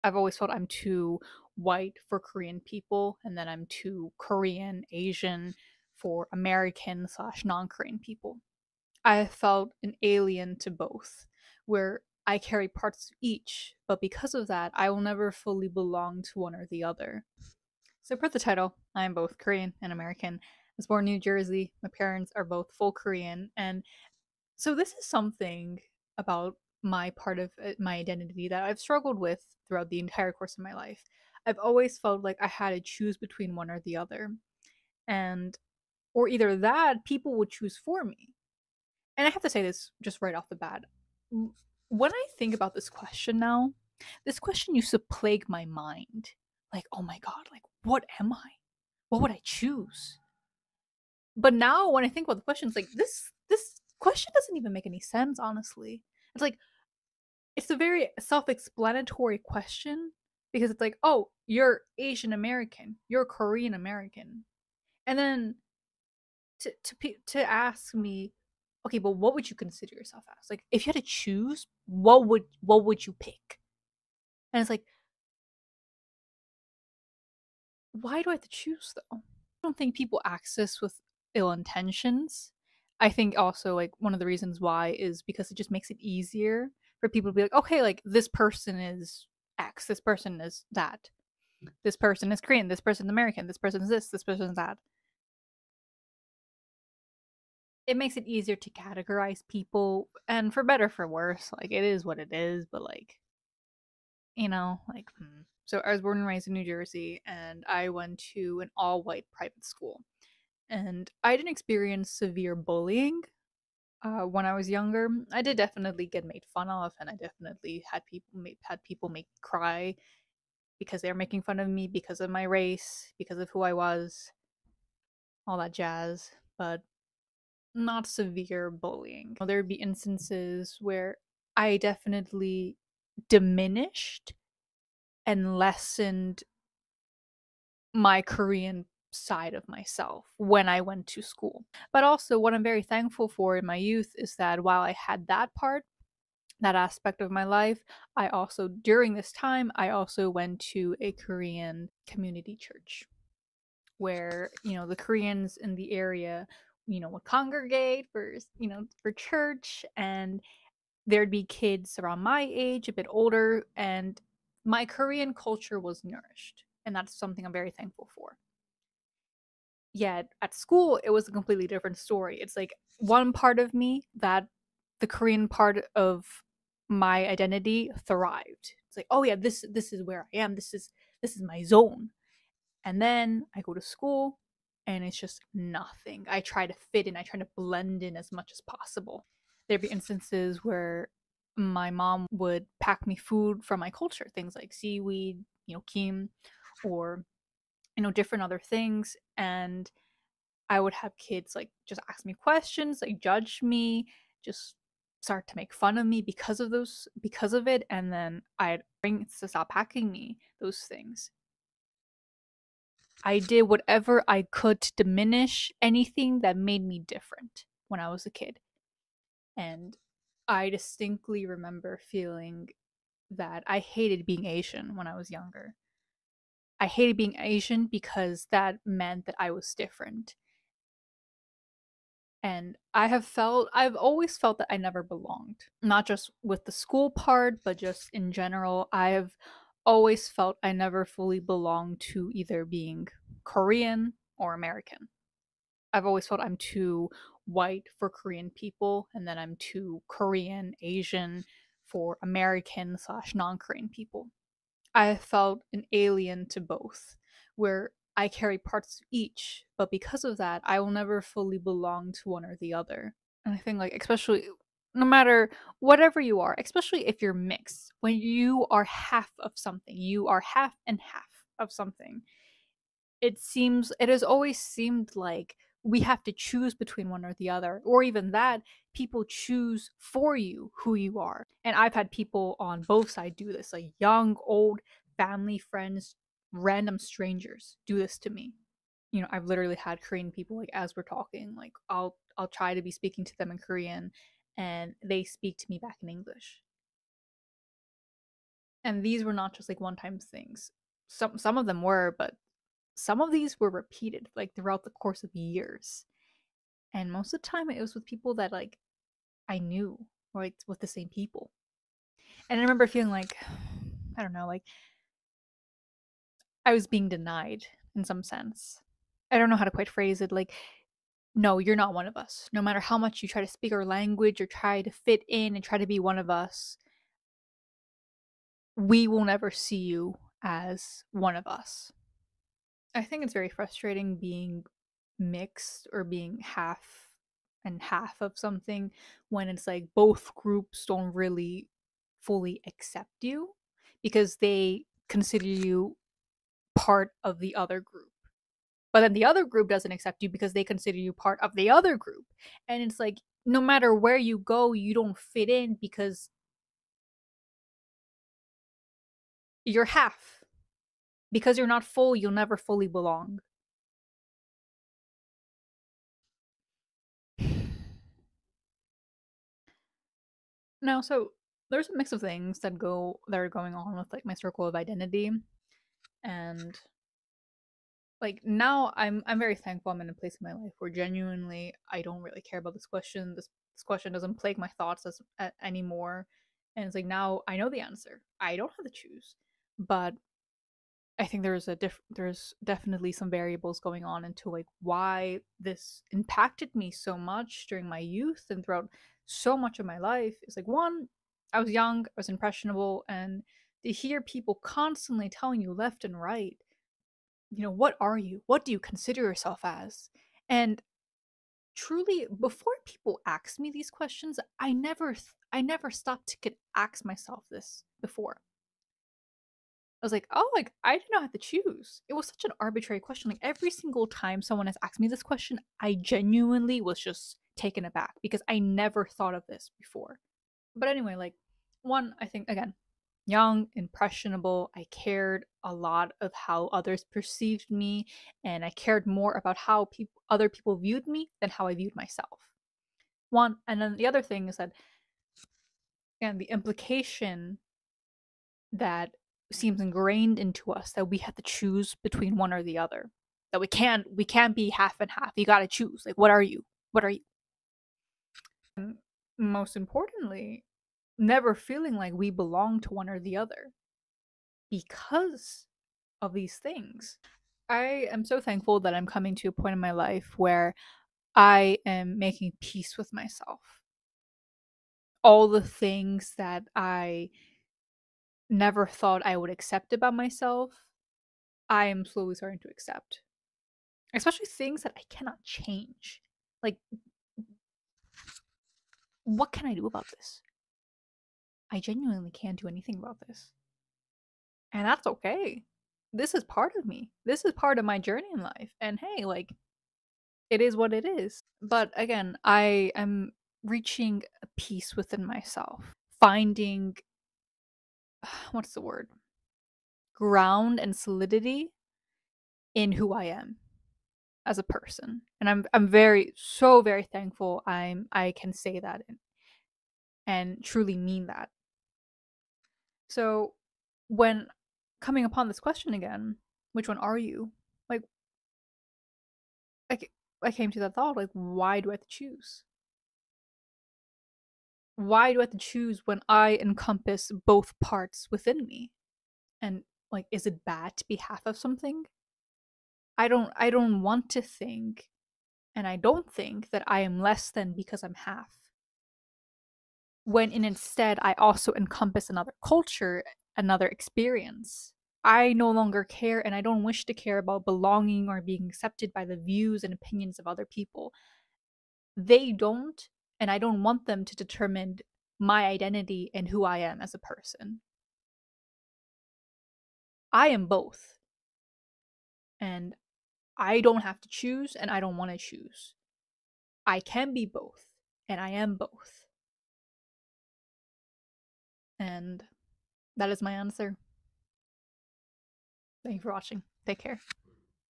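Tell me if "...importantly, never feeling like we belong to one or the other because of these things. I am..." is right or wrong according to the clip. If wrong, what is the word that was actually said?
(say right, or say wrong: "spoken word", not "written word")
right.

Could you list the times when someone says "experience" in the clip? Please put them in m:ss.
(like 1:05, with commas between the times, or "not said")
1:51, 9:13.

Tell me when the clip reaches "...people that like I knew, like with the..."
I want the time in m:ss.
5:08.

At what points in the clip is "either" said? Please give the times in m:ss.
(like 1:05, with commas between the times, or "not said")
0:36, 4:02.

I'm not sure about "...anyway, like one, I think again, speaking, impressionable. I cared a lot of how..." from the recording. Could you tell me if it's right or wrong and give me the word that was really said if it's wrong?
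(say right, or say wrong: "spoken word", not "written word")
wrong: "young", not "speaking".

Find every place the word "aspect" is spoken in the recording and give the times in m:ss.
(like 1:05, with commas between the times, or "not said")
2:26.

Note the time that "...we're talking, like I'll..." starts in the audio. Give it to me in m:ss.
4:50.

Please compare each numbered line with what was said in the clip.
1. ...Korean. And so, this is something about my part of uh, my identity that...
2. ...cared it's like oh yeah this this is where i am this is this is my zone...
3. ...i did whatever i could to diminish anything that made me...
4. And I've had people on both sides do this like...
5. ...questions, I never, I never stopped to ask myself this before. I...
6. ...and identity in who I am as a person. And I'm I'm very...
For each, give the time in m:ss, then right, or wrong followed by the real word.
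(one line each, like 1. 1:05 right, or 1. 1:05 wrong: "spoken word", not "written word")
1. 0:22 right
2. 2:58 wrong: "thrived", not "cared"
3. 3:33 right
4. 4:41 right
5. 6:53 right
6. 8:30 wrong: "solidity", not "identity".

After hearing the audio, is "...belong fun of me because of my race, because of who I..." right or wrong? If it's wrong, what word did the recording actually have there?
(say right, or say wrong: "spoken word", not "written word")
wrong: "making", not "belong".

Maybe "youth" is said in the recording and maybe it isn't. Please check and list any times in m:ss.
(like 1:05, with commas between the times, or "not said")
2:23, 6:37.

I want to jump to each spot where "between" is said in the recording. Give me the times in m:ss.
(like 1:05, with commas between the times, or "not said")
0:33, 4:36, 7:32.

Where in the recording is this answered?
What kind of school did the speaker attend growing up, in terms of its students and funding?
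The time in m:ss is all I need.
1:48.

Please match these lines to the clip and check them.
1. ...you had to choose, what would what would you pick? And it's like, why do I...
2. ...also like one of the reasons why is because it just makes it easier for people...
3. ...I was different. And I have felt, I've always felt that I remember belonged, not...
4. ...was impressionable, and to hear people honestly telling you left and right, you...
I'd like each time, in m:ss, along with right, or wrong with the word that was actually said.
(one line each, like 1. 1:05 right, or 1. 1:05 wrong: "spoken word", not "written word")
1. 1:10 right
2. 1:23 right
3. 3:49 wrong: "never", not "remember"
4. 6:42 wrong: "constantly", not "honestly".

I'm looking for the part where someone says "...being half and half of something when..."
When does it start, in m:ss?
5:36.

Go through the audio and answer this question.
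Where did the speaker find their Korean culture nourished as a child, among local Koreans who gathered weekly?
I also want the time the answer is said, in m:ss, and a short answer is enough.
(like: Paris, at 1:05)
Korean community church, at 2:31.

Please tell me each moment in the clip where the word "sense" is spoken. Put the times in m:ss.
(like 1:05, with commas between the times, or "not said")
0:54, 5:18.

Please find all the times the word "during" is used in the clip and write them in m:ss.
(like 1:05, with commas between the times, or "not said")
2:28, 6:37.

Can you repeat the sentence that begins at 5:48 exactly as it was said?
But then the other group doesn't accept you because they consider you part of the other group.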